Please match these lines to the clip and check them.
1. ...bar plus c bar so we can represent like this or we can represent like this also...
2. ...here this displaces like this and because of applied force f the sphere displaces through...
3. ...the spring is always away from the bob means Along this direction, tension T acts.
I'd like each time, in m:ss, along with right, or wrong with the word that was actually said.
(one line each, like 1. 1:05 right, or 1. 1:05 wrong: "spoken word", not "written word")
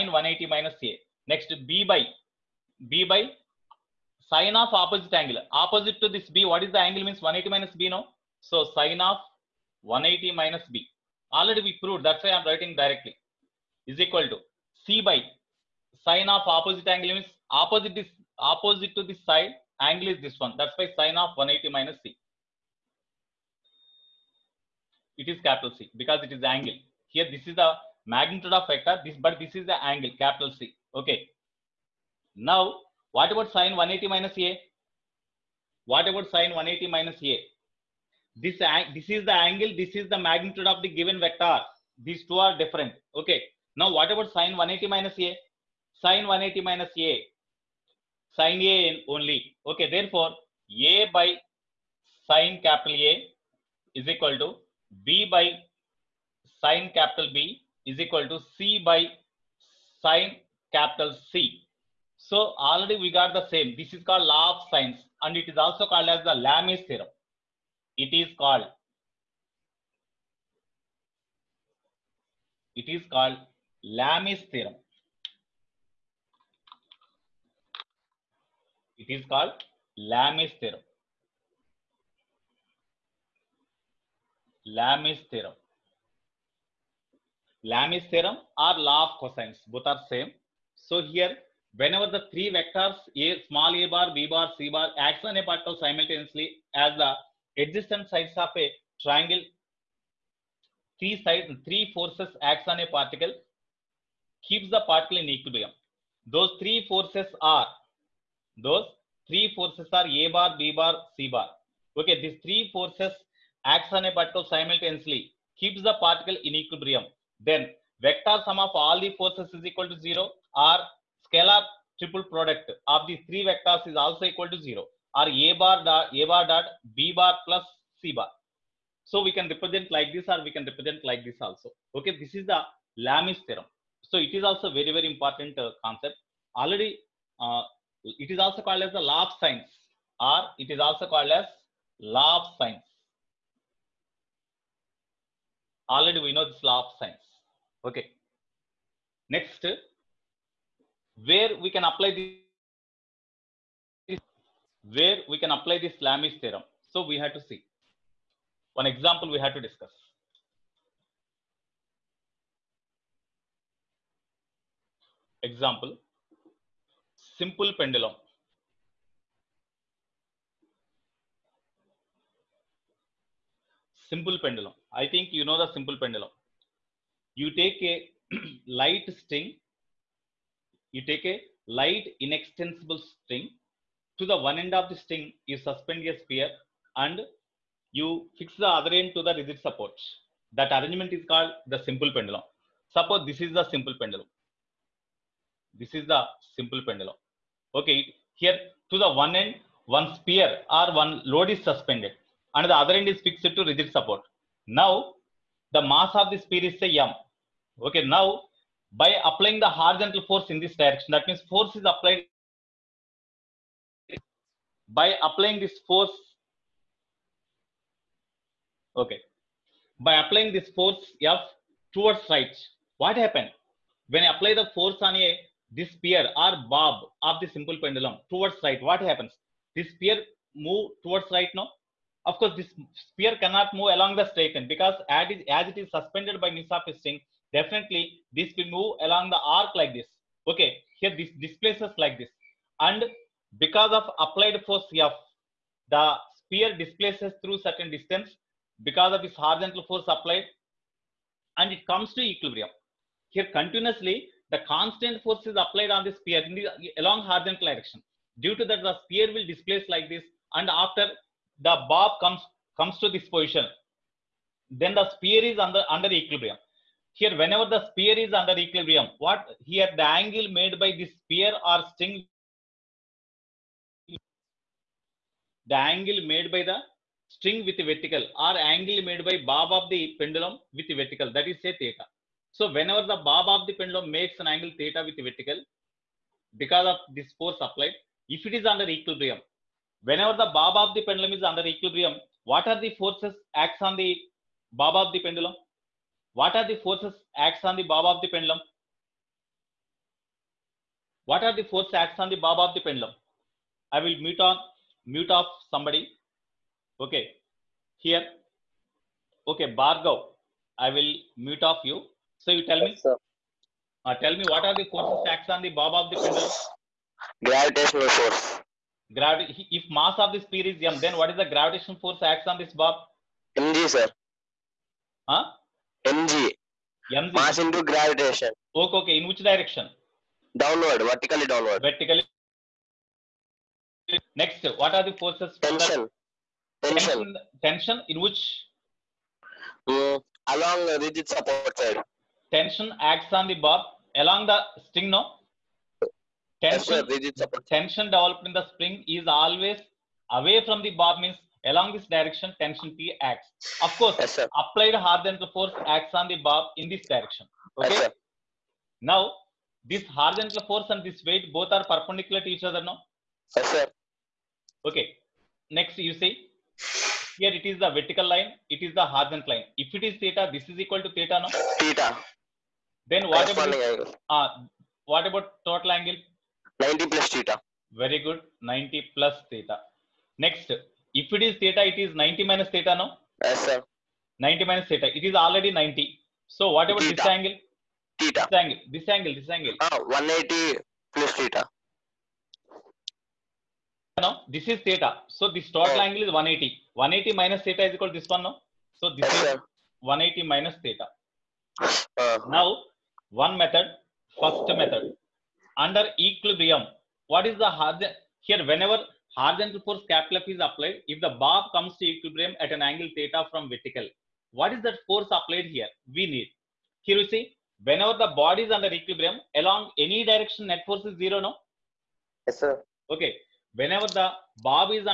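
1. 2:07 right
2. 4:00 right
3. 5:48 right.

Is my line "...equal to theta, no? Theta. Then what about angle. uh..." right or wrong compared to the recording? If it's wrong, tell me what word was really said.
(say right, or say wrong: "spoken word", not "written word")
right.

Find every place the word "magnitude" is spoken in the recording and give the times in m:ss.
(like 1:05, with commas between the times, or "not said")
0:28, 0:40.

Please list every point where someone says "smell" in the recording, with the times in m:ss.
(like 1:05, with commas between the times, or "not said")
not said.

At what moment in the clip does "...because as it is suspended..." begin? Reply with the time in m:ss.
3:54.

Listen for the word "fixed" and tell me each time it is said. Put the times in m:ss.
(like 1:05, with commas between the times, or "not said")
3:23.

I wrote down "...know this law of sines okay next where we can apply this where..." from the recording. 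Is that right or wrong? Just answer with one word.
right.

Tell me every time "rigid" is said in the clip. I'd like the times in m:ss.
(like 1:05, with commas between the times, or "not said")
3:09, 3:23, 5:41, 5:47.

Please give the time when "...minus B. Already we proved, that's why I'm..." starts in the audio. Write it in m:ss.
0:10.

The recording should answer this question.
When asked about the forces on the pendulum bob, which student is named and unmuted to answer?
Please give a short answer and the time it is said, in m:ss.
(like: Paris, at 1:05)
Bhargav, at 5:09.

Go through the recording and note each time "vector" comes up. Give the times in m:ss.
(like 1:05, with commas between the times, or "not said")
0:28, 0:41, 1:32, 1:58, 2:03.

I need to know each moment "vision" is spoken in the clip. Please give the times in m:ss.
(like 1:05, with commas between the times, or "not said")
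not said.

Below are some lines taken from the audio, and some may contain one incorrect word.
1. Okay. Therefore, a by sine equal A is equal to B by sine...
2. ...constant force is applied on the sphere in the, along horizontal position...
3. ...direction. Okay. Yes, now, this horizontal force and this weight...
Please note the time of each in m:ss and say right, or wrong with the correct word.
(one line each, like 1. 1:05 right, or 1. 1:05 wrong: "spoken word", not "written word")
1. 0:49 wrong: "capital", not "equal"
2. 4:14 wrong: "direction", not "position"
3. 5:57 right.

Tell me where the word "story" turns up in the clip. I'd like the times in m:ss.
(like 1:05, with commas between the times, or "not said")
not said.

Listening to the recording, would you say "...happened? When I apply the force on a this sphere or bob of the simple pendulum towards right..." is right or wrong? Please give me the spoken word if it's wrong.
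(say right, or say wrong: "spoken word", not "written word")
right.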